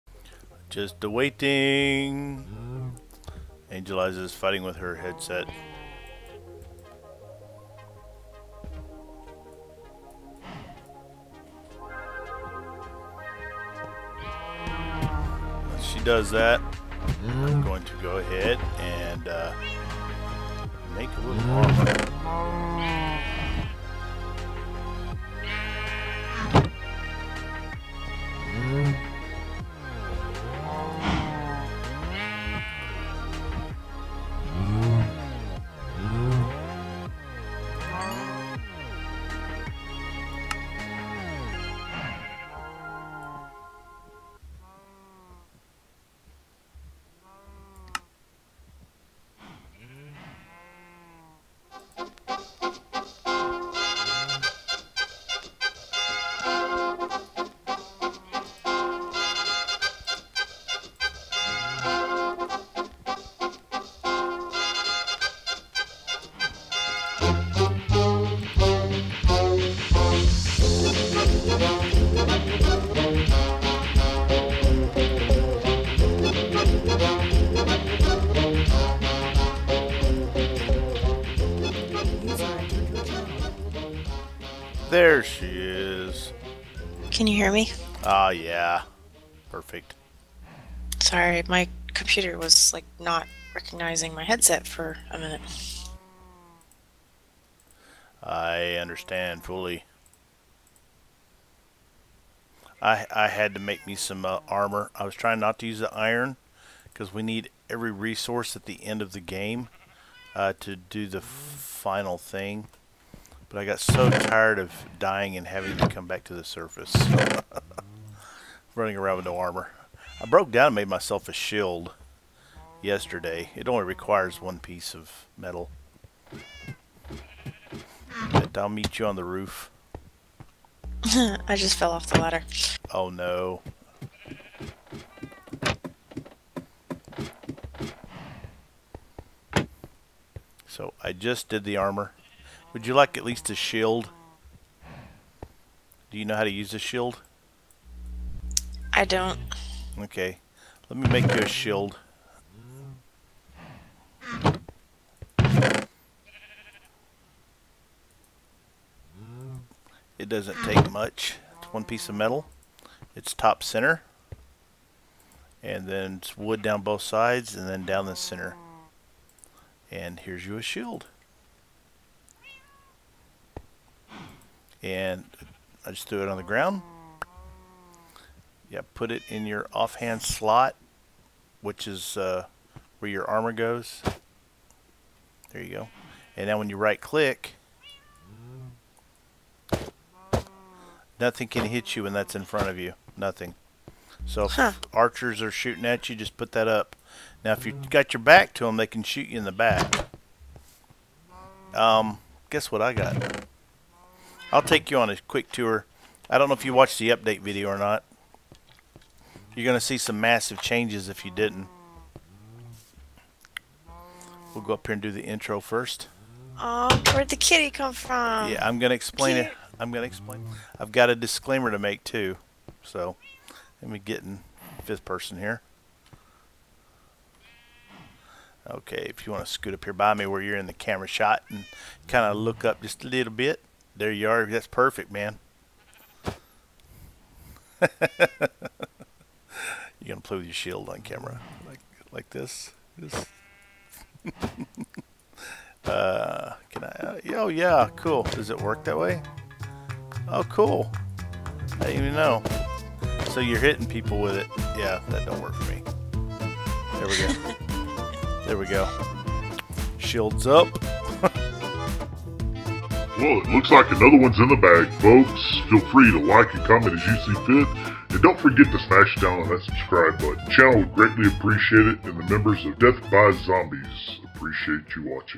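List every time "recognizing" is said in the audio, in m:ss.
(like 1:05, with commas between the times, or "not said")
1:33.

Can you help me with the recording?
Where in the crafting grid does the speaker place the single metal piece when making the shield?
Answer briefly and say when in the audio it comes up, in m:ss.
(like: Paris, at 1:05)
top center, at 2:43.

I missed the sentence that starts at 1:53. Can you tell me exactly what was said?
But I got so tired of dying and having to come back to the surface.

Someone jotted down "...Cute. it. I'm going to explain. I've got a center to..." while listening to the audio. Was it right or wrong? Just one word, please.
wrong.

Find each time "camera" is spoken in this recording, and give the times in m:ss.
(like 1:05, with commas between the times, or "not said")
3:50, 4:01.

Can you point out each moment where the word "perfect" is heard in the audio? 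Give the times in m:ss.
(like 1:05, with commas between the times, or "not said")
1:29, 3:54.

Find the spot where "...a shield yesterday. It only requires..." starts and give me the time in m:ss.
2:01.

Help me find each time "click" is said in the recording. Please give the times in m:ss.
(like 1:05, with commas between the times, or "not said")
3:07.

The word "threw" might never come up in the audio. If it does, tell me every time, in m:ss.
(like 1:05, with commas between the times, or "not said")
2:56.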